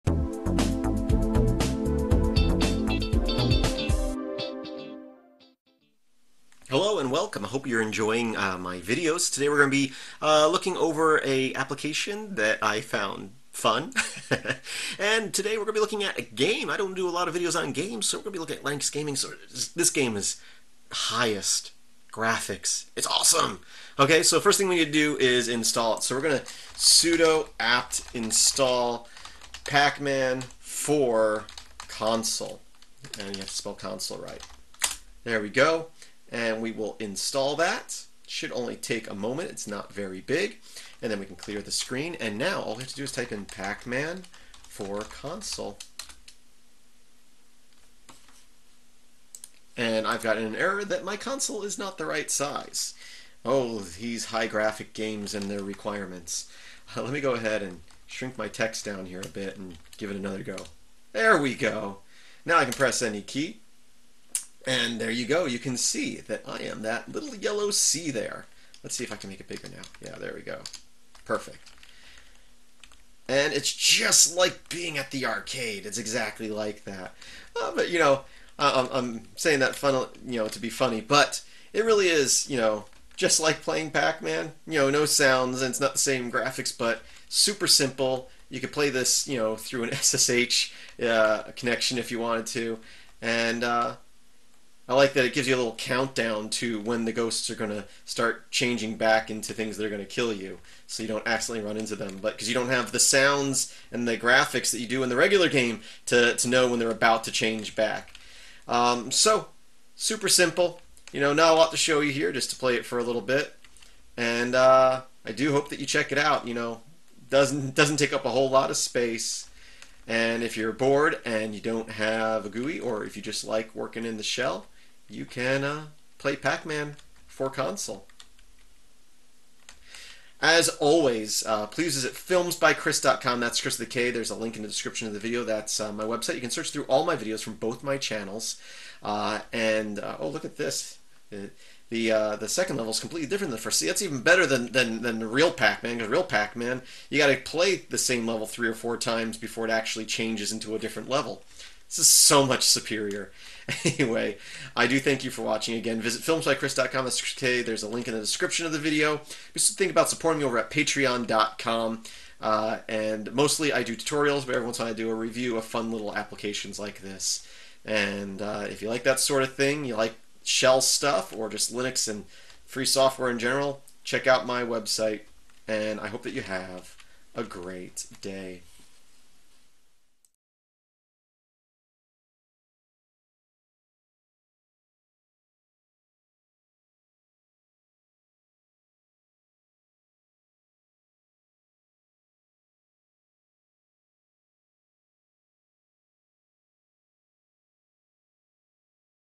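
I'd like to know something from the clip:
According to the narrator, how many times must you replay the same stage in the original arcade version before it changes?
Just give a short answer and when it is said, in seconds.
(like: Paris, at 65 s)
3 or 4, at 148 s.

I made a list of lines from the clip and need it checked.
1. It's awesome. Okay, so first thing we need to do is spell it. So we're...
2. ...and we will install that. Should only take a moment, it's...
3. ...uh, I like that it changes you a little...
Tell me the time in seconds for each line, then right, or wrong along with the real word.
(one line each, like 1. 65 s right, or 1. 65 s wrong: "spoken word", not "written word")
1. 22 s wrong: "install", not "spell"
2. 36 s right
3. 93 s wrong: "gives", not "changes".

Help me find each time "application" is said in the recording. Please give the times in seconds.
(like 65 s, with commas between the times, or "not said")
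11 s, 166 s.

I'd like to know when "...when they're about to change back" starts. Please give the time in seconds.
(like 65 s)
106 s.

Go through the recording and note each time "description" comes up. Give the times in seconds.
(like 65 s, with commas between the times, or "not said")
134 s, 158 s.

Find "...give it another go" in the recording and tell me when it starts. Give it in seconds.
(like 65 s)
59 s.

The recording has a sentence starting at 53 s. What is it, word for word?
Oh, these high graphic games and their requirements.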